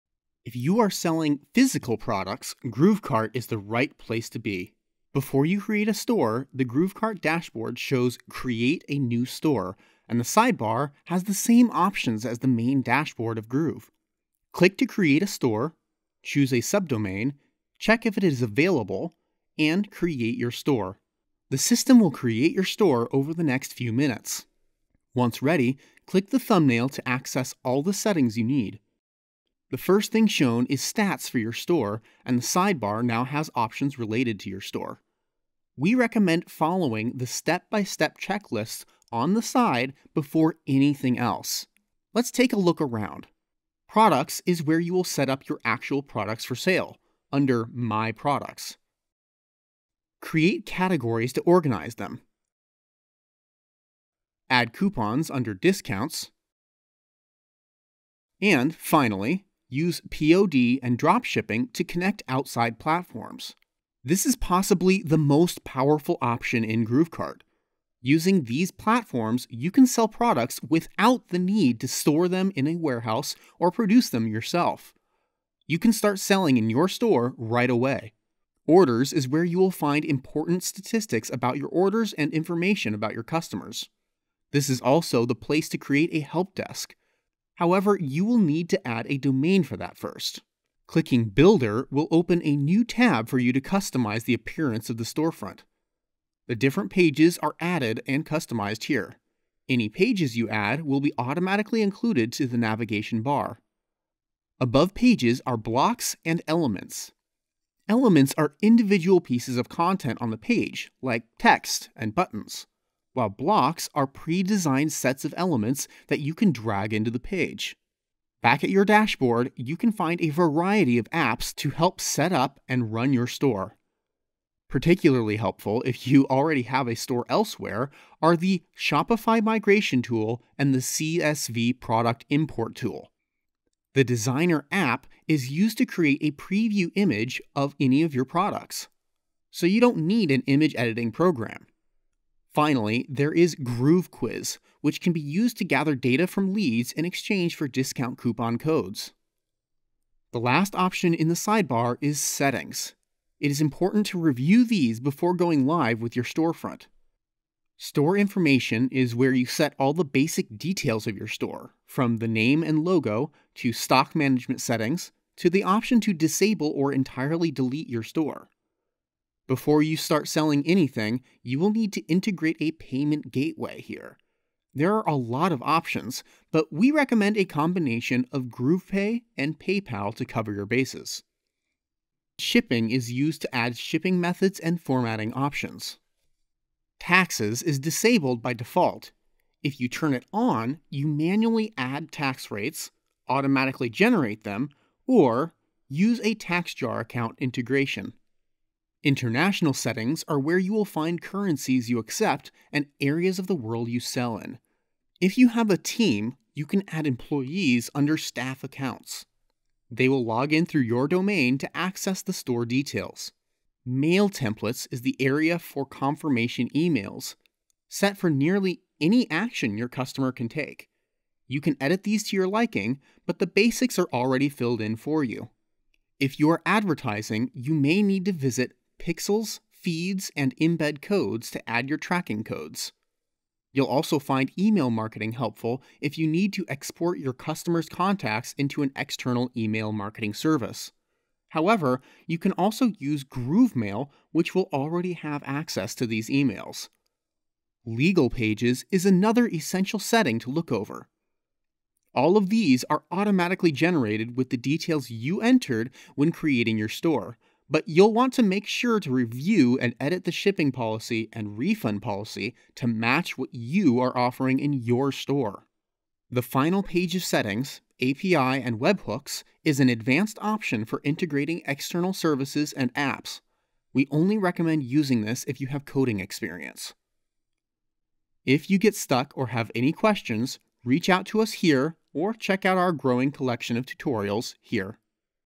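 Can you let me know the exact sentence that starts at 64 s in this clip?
This is possibly the most powerful option in GrooveKart.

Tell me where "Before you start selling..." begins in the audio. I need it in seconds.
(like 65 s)
169 s.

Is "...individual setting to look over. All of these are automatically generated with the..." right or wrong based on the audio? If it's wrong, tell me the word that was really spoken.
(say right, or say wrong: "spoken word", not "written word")
wrong: "essential", not "individual".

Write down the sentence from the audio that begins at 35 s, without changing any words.
We recommend following the step-by-step checklist on the side before anything else.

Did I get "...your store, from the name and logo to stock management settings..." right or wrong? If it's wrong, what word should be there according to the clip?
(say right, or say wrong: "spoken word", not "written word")
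right.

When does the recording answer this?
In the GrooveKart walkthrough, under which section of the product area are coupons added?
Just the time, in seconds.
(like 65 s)
55 s.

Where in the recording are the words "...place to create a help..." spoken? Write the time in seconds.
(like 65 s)
85 s.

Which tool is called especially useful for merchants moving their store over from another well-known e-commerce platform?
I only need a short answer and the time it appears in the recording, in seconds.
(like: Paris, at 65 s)
Shopify migration tool, at 128 s.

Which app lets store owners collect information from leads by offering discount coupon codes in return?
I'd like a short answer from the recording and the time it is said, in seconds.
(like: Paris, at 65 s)
Groove Quiz, at 143 s.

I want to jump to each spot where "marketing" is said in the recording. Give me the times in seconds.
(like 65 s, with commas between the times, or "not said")
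234 s, 239 s.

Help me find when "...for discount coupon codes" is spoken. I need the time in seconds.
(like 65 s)
147 s.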